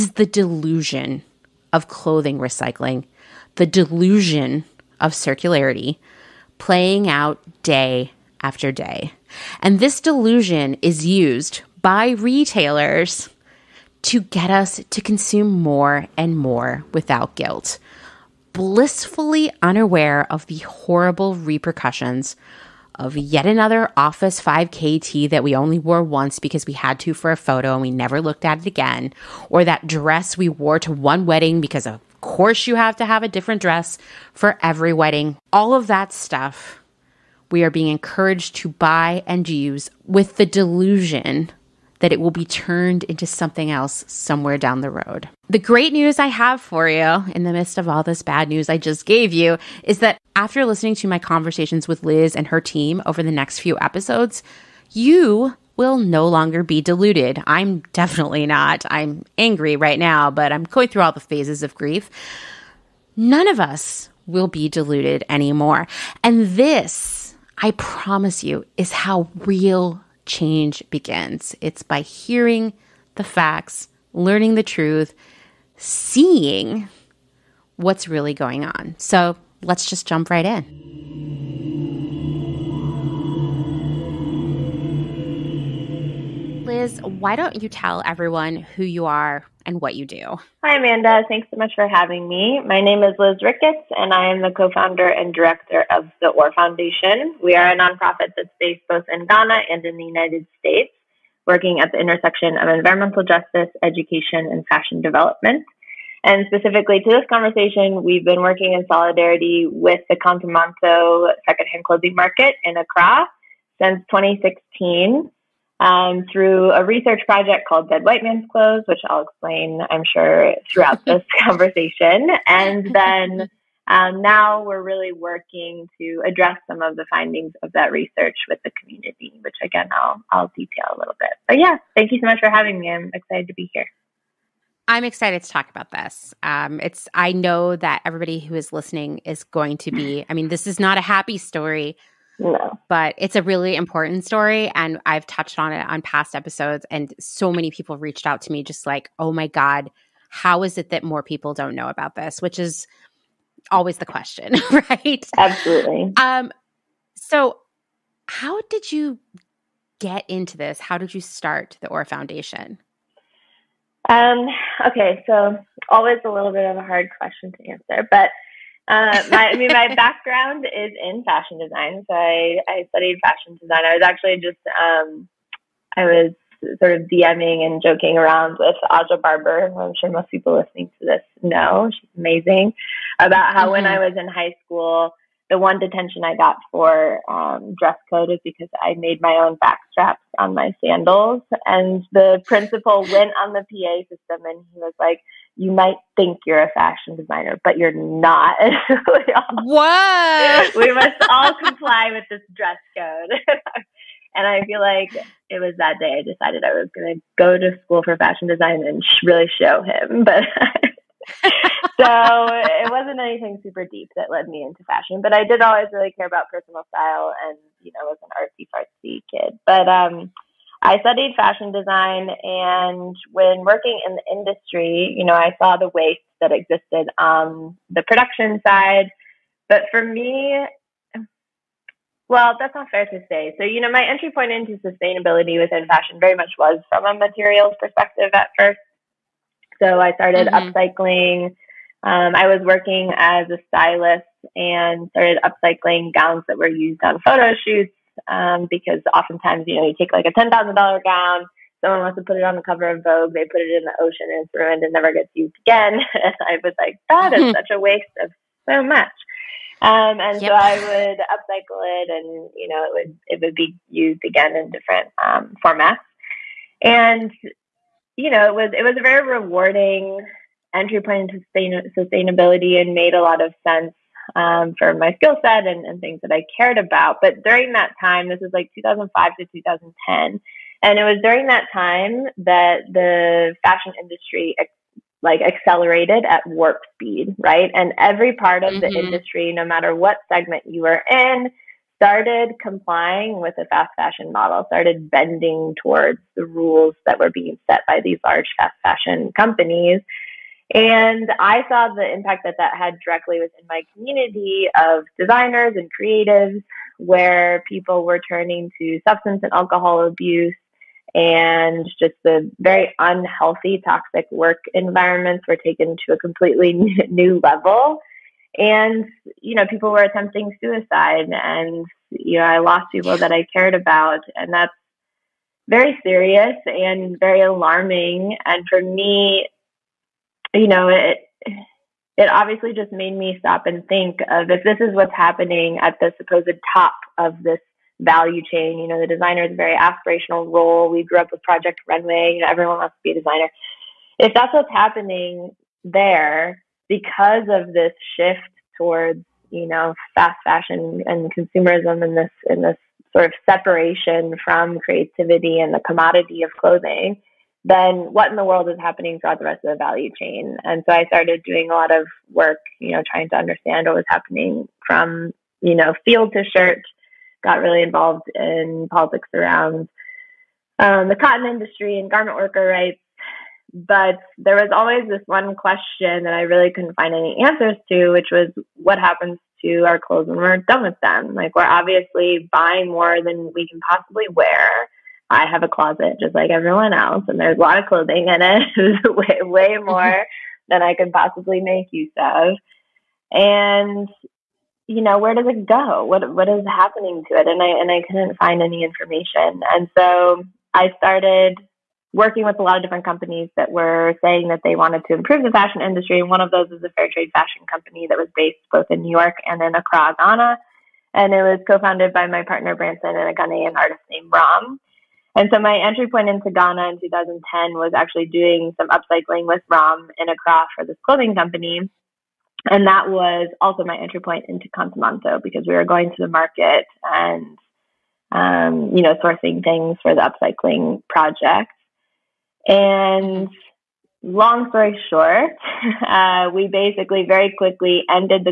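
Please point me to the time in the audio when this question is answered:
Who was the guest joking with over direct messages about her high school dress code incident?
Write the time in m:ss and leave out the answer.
2:58.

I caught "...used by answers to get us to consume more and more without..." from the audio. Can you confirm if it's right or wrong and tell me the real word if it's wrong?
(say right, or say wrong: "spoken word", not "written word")
wrong: "retailers", not "answers".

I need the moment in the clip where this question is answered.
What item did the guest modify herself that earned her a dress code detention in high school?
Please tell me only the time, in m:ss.
3:10.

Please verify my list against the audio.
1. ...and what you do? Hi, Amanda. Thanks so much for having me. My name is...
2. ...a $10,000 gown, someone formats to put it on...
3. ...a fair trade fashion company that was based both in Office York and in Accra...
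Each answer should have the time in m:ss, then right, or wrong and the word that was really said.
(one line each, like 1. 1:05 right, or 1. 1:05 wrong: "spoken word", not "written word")
1. 1:29 right
2. 4:10 wrong: "wants", not "formats"
3. 6:46 wrong: "New", not "Office".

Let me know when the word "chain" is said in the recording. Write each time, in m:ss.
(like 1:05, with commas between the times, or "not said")
5:38, 6:00.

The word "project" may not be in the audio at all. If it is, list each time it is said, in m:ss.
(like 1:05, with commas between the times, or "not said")
1:57, 5:41, 7:11.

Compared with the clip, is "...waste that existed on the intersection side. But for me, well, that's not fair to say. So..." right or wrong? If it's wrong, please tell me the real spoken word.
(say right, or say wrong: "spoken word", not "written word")
wrong: "production", not "intersection".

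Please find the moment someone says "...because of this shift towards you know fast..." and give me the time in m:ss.
5:46.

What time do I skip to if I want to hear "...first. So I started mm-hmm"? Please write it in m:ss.
3:58.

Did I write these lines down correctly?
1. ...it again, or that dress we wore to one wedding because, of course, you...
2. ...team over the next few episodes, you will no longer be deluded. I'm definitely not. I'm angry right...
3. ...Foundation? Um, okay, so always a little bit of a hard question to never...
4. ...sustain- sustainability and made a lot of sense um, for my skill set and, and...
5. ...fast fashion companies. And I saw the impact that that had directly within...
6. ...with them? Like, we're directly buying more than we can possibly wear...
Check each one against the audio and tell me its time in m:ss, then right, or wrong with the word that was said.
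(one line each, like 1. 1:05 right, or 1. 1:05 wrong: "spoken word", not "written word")
1. 0:28 right
2. 0:52 right
3. 2:42 wrong: "answer", not "never"
4. 4:31 right
5. 4:58 right
6. 6:20 wrong: "obviously", not "directly".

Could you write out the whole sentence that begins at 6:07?
Got really involved in politics around um, the cotton industry and garment worker rights.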